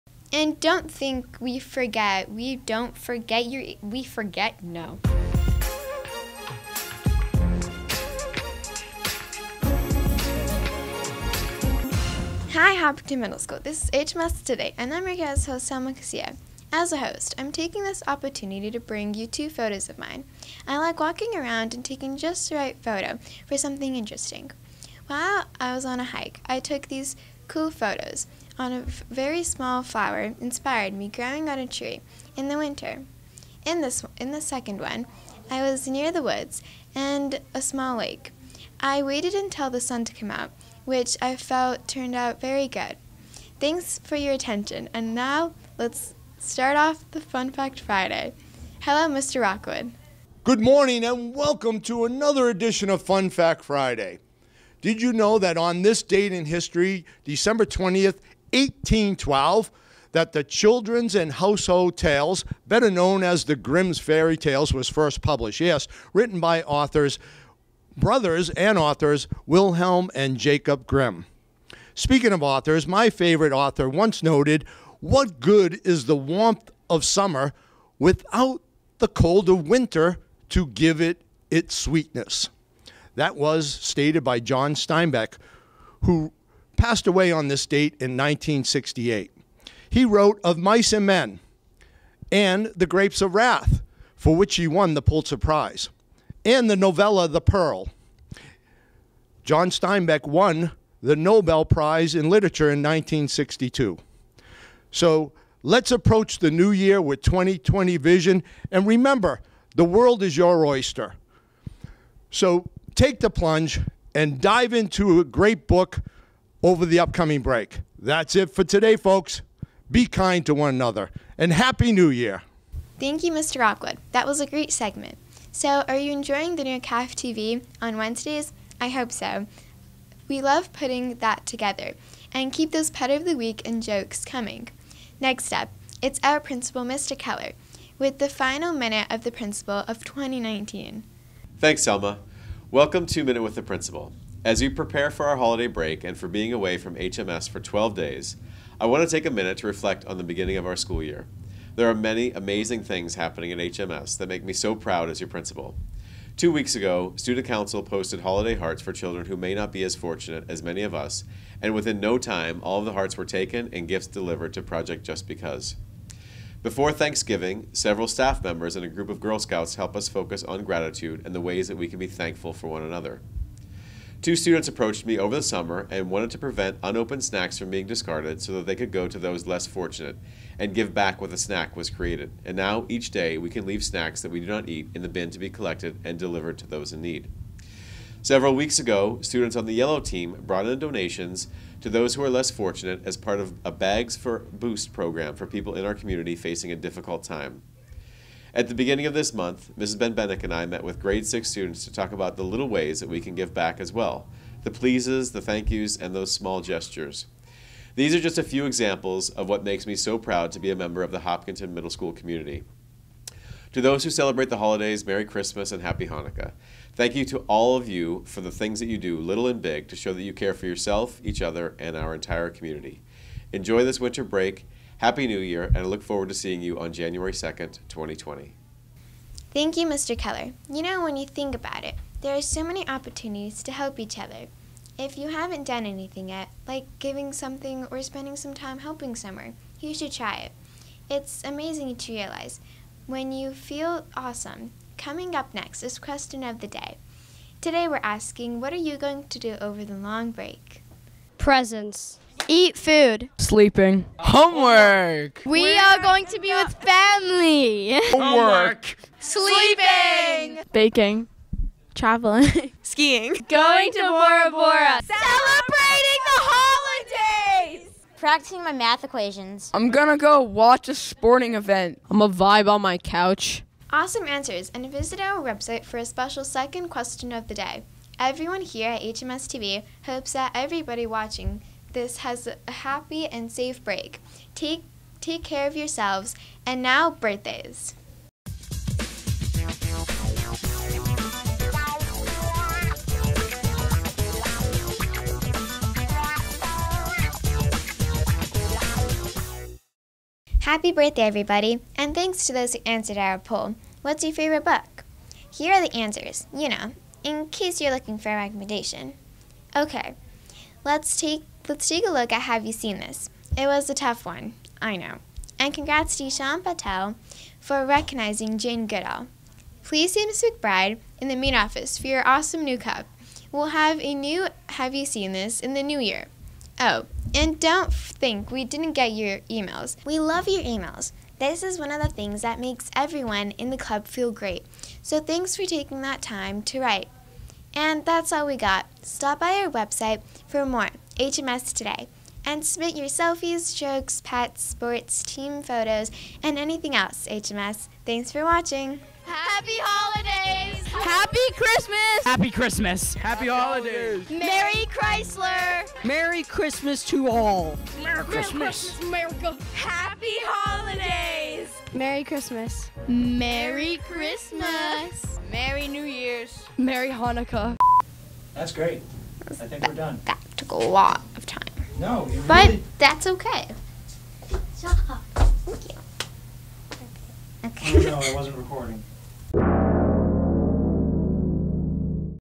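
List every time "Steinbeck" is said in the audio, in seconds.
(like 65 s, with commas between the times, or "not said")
84 s, 99 s.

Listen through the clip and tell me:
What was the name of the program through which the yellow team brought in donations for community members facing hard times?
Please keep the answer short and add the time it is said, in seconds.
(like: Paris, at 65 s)
Bags for Boost, at 193 s.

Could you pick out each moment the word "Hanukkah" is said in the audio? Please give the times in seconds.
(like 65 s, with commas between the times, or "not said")
216 s, 367 s.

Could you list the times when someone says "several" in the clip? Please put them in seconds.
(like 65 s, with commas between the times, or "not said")
167 s, 188 s.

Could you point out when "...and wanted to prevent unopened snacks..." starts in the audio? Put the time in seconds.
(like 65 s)
175 s.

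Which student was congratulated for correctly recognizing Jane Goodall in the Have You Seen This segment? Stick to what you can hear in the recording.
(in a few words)
Sean Patel.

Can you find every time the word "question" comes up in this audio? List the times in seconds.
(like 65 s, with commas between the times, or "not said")
245 s, 276 s.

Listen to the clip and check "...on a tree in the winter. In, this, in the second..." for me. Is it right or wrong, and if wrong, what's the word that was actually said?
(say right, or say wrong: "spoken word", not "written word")
right.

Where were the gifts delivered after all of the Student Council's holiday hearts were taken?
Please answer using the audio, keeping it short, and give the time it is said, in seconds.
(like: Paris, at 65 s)
Project Just Because, at 164 s.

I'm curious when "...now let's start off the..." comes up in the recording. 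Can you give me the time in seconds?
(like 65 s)
45 s.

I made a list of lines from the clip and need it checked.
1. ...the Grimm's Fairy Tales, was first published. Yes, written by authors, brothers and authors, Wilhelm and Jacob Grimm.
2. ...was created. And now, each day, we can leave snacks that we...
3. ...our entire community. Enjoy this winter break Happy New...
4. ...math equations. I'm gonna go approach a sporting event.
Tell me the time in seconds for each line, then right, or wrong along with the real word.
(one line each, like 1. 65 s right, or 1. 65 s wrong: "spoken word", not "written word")
1. 63 s right
2. 181 s right
3. 221 s right
4. 268 s wrong: "watch", not "approach".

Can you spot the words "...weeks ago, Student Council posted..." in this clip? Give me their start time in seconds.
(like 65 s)
156 s.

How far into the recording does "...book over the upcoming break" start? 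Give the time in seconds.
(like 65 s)
115 s.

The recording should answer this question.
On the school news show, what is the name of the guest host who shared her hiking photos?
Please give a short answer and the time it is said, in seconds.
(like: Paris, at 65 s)
Selma Casilla, at 15 s.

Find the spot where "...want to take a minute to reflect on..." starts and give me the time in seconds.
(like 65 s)
148 s.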